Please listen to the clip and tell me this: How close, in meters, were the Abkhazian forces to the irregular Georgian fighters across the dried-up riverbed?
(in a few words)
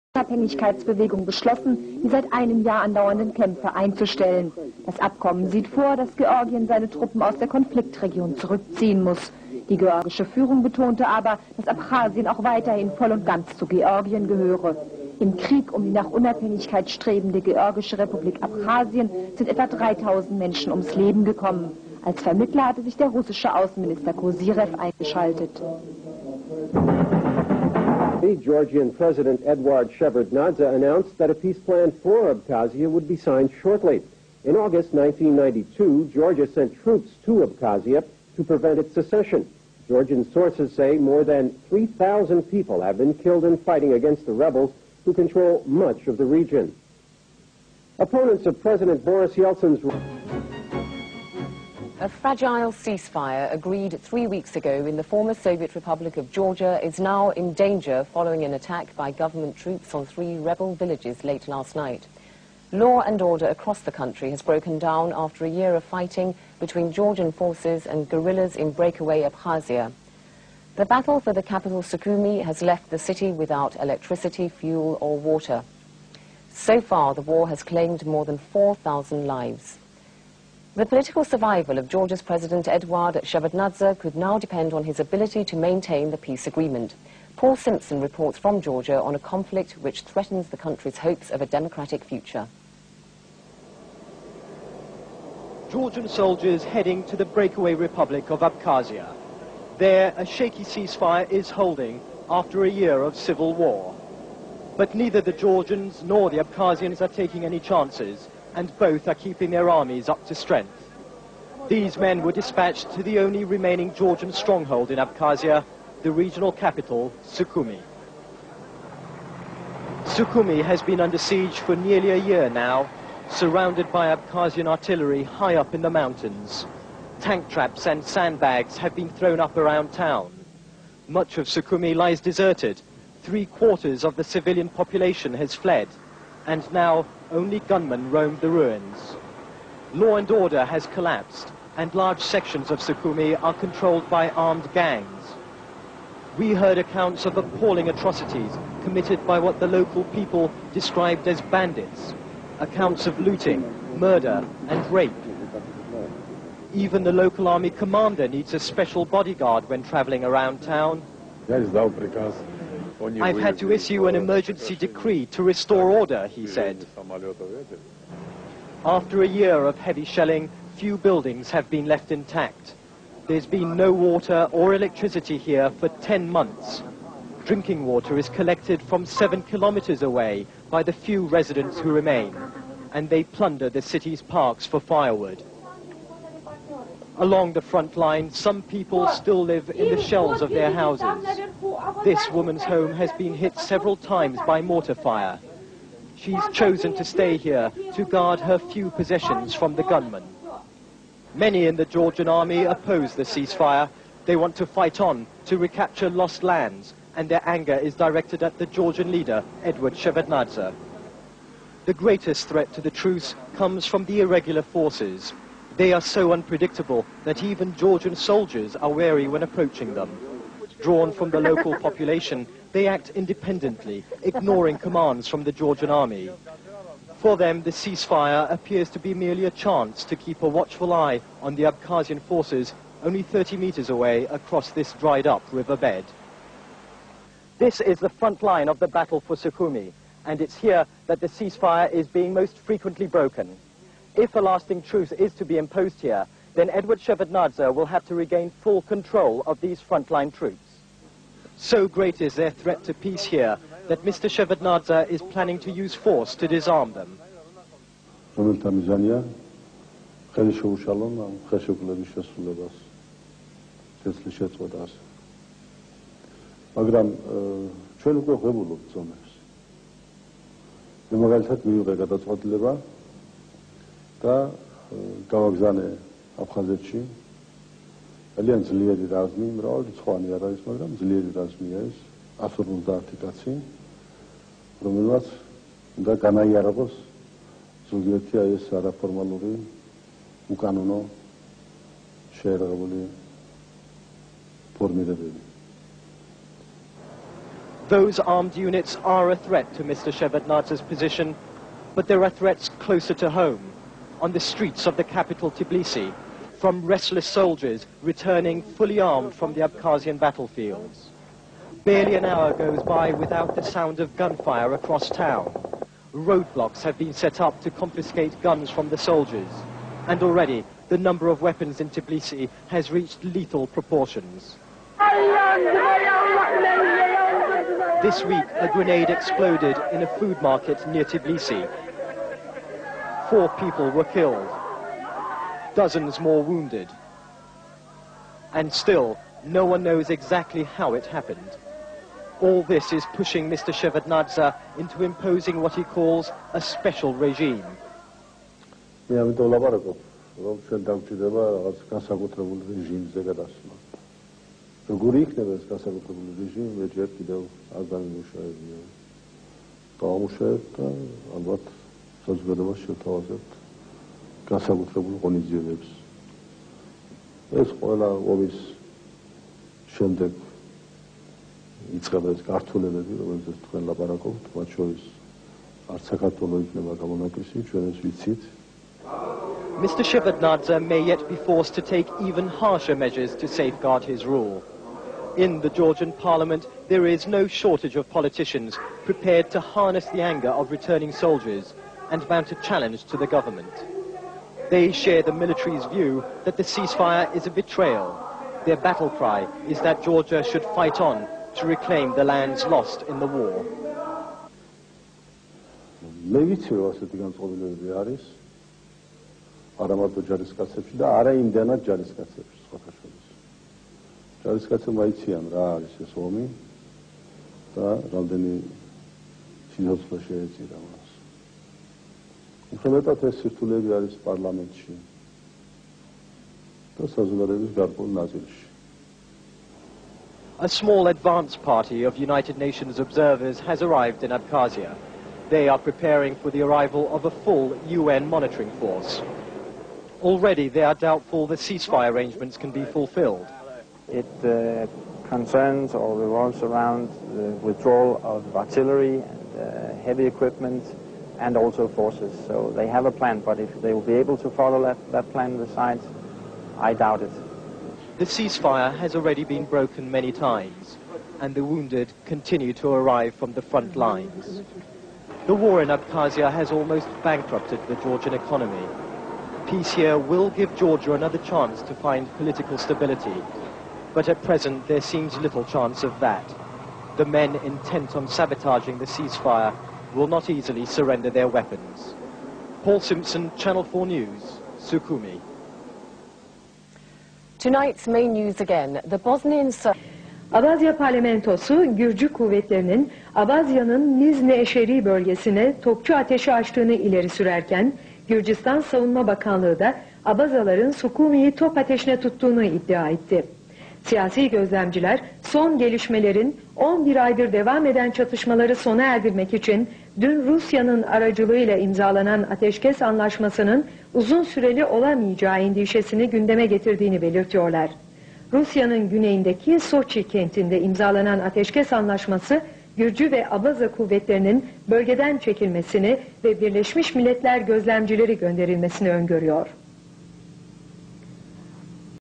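30.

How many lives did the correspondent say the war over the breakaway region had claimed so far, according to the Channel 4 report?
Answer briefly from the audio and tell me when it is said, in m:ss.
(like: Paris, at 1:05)
More than 4,000, at 1:18.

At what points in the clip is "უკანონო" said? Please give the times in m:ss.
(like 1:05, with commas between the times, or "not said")
4:50.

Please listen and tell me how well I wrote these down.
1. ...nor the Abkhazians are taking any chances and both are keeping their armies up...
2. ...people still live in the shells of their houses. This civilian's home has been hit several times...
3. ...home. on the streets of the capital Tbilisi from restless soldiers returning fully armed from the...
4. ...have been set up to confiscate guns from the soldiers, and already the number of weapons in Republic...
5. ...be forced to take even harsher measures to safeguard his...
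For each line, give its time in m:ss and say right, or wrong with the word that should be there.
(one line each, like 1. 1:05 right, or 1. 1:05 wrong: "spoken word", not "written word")
1. 1:46 right
2. 3:08 wrong: "woman", not "civilian"
3. 5:03 right
4. 5:16 wrong: "Tbilisi", not "Republic"
5. 6:21 right.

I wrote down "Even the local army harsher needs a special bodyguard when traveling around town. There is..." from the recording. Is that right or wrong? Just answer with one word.
wrong.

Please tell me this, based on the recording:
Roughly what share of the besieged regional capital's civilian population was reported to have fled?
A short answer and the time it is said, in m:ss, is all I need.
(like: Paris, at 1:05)
Three quarters, at 2:13.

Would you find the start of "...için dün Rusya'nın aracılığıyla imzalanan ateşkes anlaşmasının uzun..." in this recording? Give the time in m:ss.
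8:29.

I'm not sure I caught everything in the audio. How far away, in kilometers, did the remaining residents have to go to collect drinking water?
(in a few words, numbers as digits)
7.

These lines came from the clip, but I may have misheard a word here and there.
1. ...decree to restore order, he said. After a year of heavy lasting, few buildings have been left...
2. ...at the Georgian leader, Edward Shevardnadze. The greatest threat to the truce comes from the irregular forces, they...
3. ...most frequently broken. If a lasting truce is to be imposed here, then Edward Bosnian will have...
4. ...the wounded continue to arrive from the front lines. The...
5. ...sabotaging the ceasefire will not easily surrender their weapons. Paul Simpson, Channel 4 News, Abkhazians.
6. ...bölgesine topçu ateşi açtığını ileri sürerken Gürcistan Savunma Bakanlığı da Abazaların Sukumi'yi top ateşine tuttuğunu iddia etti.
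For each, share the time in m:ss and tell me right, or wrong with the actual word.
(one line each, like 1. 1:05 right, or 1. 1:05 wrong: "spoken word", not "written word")
1. 2:44 wrong: "shelling", not "lasting"
2. 3:28 right
3. 4:02 wrong: "Shevardnadze", not "Bosnian"
4. 7:41 right
5. 7:58 wrong: "Sukumi", not "Abkhazians"
6. 8:15 right.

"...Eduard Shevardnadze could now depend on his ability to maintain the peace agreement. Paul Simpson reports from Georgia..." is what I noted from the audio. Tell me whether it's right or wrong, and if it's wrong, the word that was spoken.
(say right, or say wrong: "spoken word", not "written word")
right.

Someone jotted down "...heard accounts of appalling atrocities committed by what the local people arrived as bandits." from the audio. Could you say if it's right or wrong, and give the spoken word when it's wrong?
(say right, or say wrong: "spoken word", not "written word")
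wrong: "described", not "arrived".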